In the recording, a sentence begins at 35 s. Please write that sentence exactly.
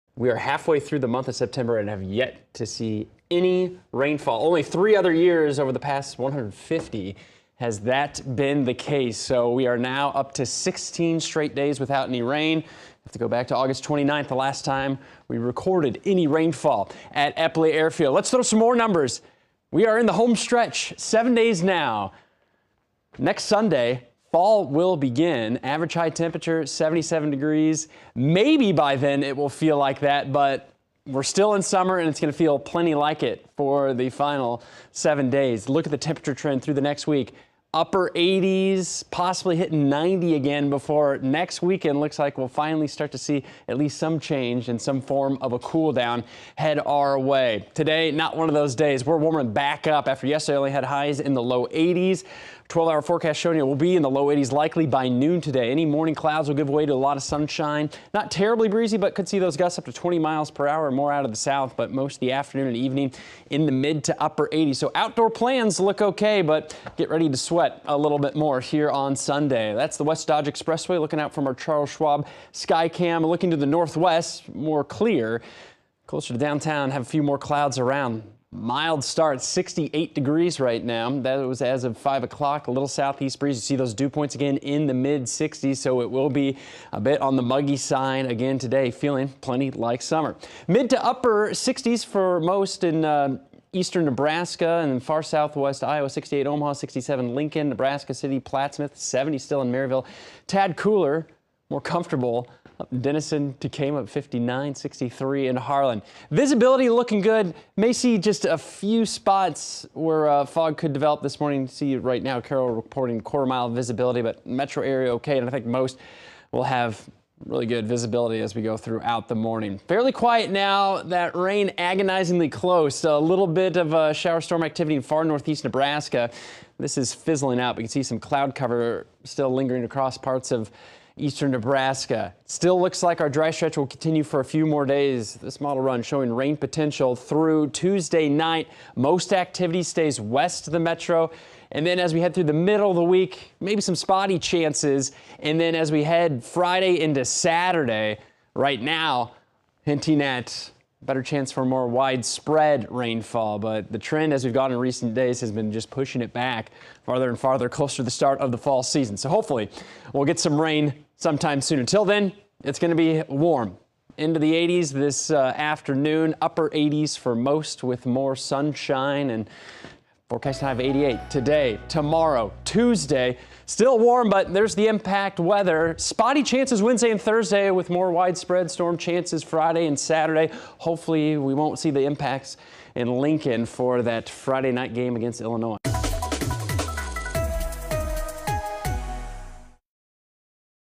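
Look at the temperature trend through the next week.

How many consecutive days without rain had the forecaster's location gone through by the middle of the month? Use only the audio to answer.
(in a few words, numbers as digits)
16.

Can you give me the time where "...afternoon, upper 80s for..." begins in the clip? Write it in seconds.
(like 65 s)
165 s.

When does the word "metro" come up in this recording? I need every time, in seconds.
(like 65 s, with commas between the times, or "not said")
114 s, 140 s.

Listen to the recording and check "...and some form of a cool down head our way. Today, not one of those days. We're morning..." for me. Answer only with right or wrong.
wrong.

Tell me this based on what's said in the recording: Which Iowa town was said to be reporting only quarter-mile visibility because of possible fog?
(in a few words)
Carroll.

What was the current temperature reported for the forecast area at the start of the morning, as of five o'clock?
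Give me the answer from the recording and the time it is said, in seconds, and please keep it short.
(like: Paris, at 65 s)
68 degrees, at 79 s.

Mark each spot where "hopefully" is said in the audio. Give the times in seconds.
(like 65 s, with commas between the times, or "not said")
159 s, 180 s.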